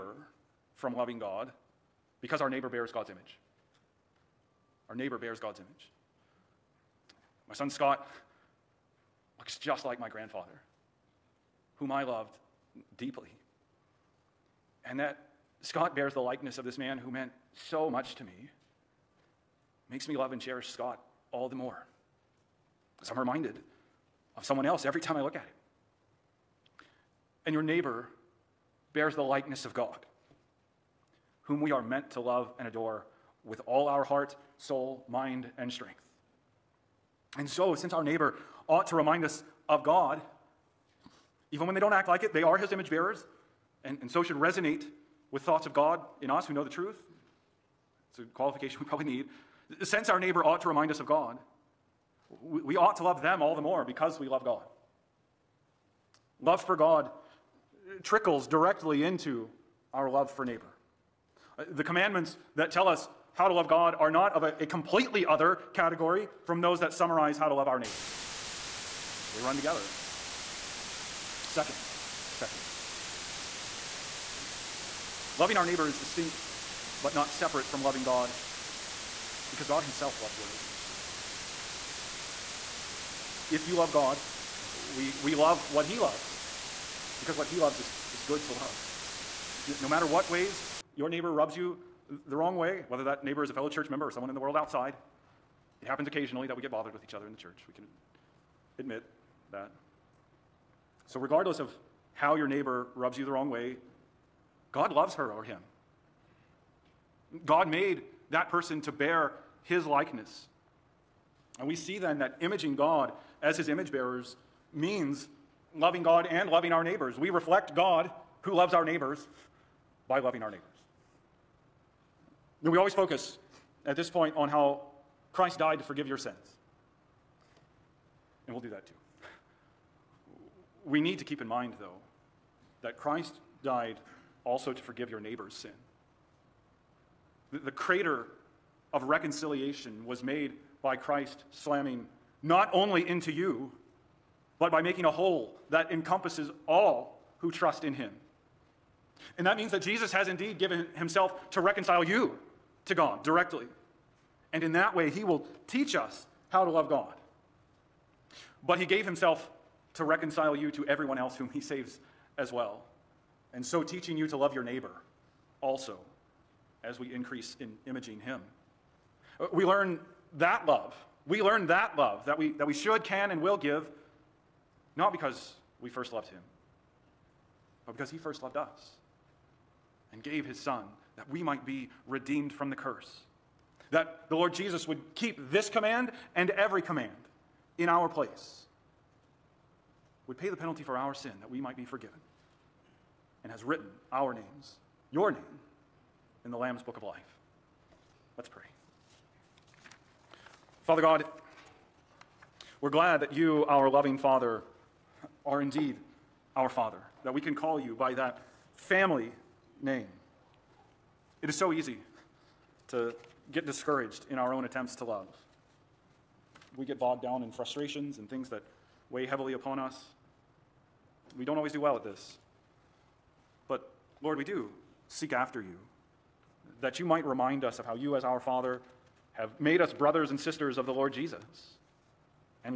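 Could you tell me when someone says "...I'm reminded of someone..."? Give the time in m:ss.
0:23.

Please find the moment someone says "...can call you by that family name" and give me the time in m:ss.
3:27.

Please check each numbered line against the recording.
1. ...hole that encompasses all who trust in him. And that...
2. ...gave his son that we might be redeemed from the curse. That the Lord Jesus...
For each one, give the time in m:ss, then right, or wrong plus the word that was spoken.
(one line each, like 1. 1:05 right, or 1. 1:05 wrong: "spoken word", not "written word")
1. 2:25 right
2. 3:00 right.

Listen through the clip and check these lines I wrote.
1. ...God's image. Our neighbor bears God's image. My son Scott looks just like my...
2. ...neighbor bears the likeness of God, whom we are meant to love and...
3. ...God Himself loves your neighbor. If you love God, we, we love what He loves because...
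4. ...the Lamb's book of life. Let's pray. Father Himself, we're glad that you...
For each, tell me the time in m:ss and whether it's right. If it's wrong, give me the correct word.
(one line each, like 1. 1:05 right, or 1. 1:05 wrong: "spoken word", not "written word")
1. 0:02 right
2. 0:27 right
3. 1:19 right
4. 3:16 wrong: "God", not "Himself".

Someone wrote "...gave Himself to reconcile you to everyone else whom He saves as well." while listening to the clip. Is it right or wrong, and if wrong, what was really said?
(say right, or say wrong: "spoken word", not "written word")
right.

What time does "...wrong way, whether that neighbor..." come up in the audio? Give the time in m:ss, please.
1:32.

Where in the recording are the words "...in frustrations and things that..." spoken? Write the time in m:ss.
3:37.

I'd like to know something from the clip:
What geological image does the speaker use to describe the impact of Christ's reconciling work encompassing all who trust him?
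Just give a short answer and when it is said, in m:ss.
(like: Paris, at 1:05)
crater, at 2:17.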